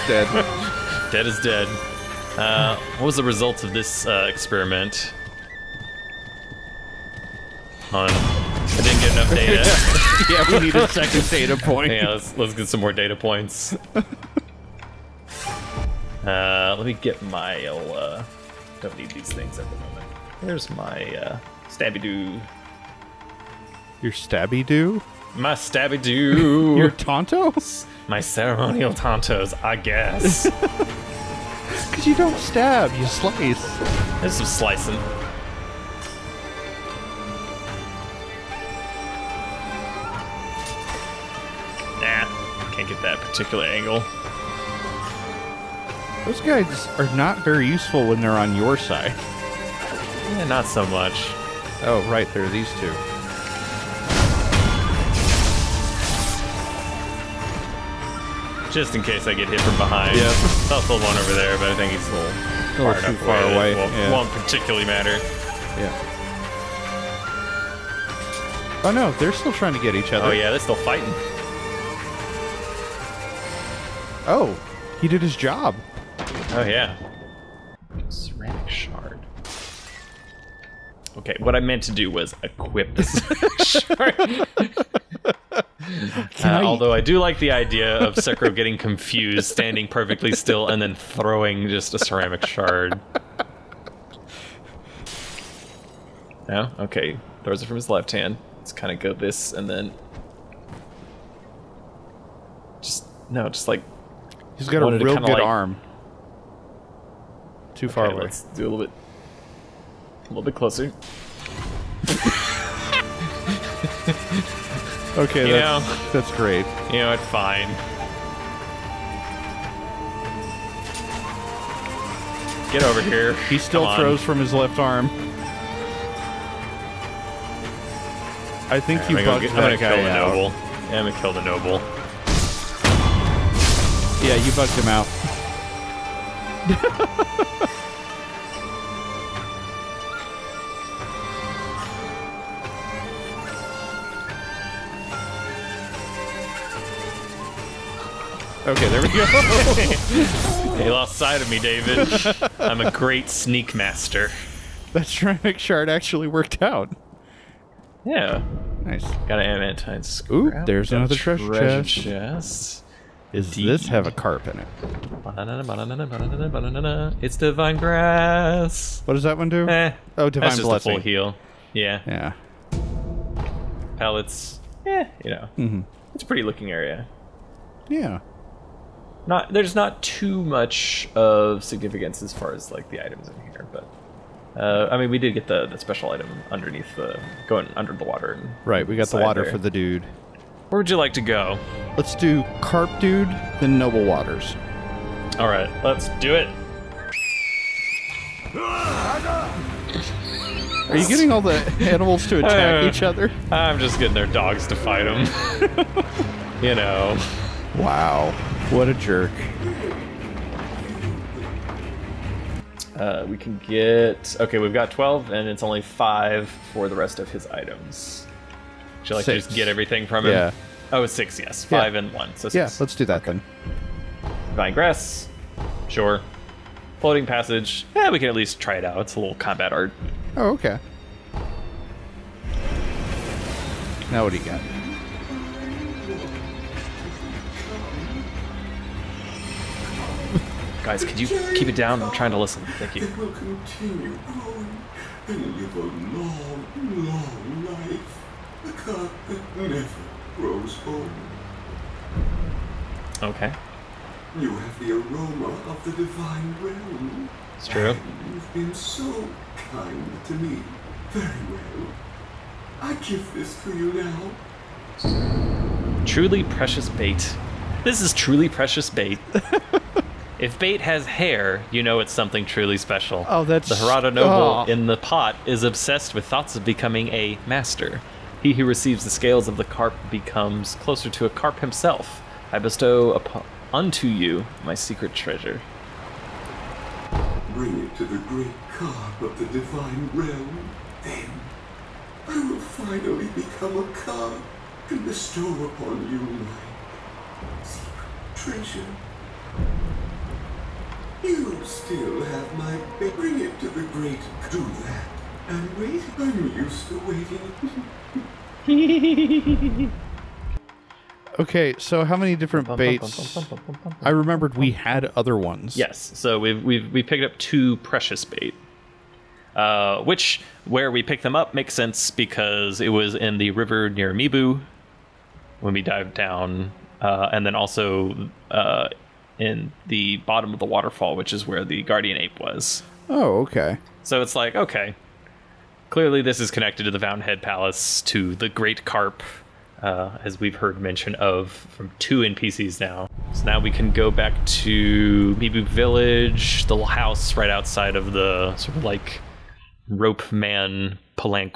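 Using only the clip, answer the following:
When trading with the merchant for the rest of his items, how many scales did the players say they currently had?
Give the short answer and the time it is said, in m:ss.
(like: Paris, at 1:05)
12, at 3:34.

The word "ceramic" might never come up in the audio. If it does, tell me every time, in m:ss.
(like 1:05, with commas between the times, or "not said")
1:18, 1:31, 2:35.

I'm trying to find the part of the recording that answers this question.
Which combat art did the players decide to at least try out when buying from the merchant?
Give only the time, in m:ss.
3:46.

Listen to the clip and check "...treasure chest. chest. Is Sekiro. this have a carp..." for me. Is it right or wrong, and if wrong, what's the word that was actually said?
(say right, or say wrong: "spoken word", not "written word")
wrong: "Deep", not "Sekiro".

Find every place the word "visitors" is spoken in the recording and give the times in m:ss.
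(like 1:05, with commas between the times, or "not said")
not said.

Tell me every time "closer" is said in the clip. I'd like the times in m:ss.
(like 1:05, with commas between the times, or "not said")
1:50, 4:40.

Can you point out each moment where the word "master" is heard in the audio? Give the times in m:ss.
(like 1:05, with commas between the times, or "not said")
2:33, 4:37.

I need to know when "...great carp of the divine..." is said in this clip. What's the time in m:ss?
4:48.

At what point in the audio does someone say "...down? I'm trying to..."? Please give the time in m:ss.
4:01.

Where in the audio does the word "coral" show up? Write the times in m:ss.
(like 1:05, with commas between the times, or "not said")
not said.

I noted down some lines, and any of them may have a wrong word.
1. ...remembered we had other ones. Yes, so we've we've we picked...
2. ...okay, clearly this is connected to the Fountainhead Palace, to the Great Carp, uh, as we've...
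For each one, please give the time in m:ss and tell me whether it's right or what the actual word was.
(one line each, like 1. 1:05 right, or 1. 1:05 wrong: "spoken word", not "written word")
1. 5:14 right
2. 5:34 right.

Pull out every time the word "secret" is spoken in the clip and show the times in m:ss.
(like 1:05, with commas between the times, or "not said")
4:44, 4:57.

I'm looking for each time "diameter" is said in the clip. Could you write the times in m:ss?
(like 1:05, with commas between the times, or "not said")
not said.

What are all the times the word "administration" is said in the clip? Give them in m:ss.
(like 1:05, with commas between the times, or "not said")
not said.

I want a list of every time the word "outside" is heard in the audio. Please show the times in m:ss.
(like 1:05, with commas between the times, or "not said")
5:47.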